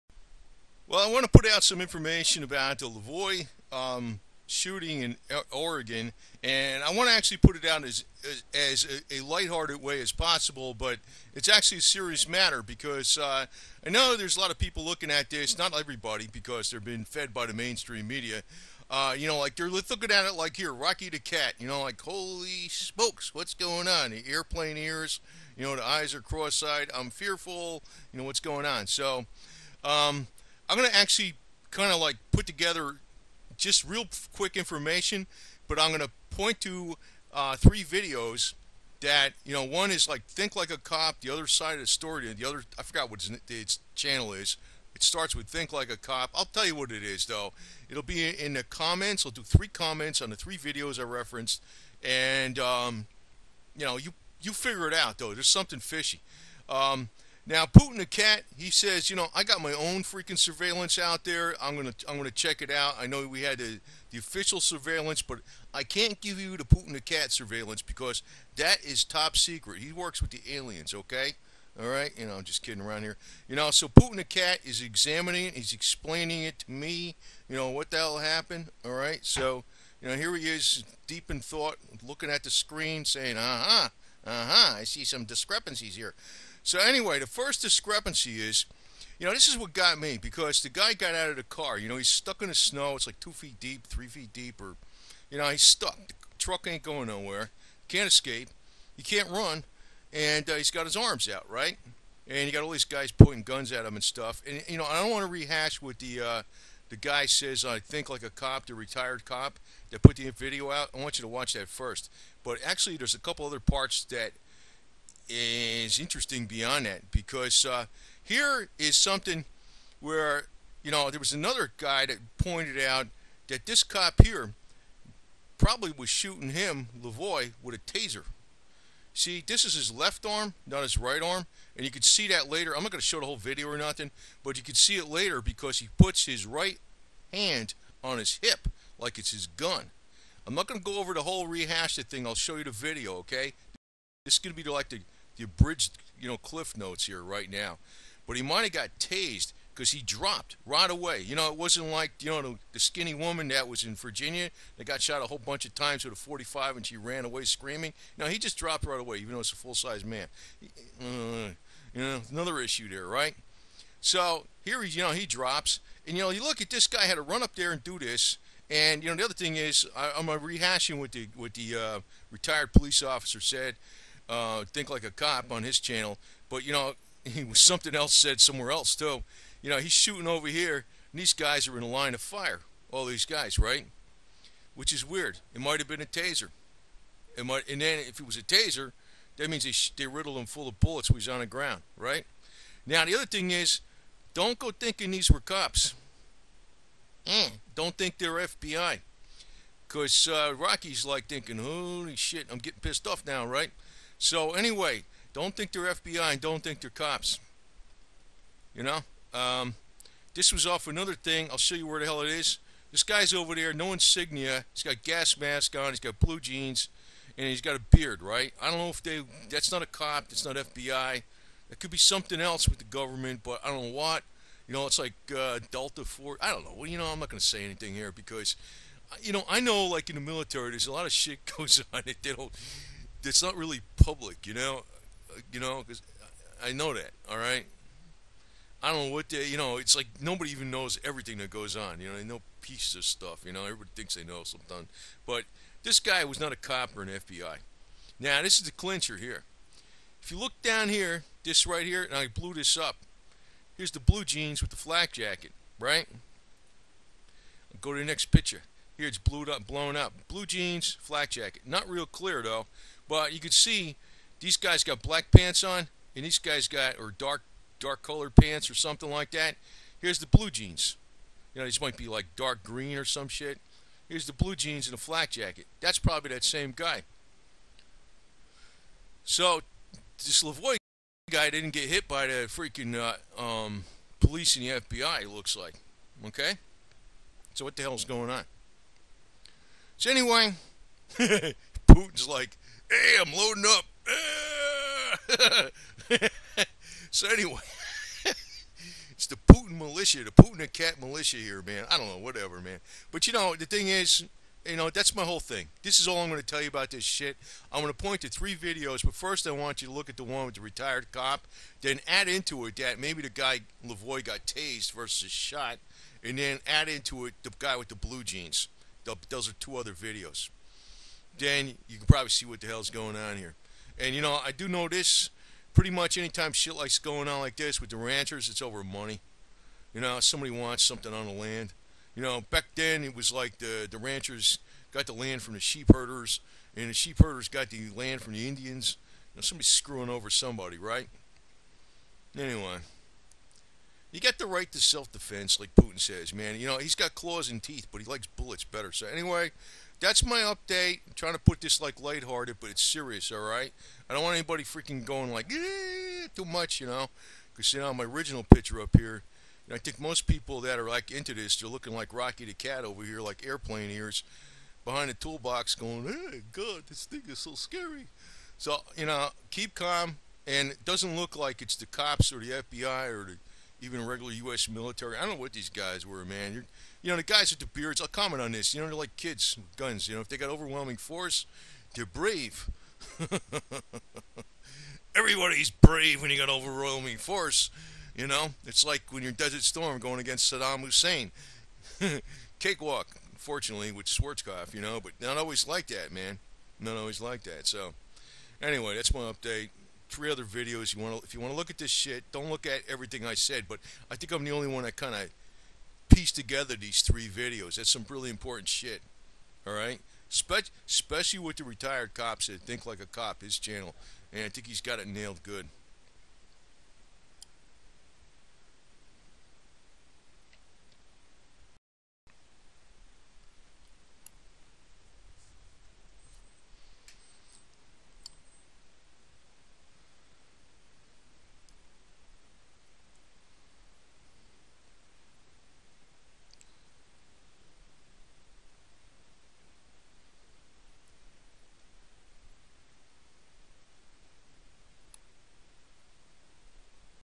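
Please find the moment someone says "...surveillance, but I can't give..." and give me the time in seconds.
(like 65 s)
64 s.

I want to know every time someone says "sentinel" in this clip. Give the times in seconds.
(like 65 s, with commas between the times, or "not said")
not said.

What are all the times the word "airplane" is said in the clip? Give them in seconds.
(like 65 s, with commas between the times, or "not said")
24 s, 363 s.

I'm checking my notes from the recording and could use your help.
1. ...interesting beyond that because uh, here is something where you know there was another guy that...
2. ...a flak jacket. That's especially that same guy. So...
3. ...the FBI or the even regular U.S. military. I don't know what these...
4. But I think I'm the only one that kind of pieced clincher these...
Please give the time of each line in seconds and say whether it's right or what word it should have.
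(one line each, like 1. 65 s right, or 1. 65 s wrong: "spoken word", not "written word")
1. 115 s right
2. 274 s wrong: "probably", not "especially"
3. 372 s right
4. 403 s wrong: "together", not "clincher".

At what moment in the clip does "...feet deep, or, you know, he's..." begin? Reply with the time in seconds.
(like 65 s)
94 s.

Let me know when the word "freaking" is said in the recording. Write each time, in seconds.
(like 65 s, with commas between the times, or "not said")
60 s, 282 s, 354 s.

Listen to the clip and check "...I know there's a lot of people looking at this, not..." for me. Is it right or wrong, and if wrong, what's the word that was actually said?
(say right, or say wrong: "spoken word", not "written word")
right.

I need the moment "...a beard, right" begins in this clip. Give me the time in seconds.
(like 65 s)
217 s.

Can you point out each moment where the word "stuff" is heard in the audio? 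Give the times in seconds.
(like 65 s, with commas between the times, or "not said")
104 s, 243 s.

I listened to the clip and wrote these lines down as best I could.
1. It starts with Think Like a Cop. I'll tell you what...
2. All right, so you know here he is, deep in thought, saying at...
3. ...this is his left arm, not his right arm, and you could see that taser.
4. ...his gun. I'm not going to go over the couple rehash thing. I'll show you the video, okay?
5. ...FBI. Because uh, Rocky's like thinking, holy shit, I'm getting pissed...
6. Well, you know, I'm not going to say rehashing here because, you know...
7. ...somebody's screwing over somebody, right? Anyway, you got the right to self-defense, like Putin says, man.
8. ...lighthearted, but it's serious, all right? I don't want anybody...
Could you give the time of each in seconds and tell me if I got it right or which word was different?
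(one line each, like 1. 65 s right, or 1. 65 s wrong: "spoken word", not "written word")
1. 44 s right
2. 78 s wrong: "looking", not "saying"
3. 129 s wrong: "later", not "taser"
4. 139 s wrong: "whole", not "couple"
5. 198 s right
6. 226 s wrong: "anything", not "rehashing"
7. 339 s right
8. 352 s right.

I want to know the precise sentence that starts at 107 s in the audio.
I think like a cop, the retired cop that put the video out.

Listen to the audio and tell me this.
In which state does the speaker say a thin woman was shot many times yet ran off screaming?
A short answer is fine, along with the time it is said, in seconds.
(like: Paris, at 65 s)
Virginia, at 153 s.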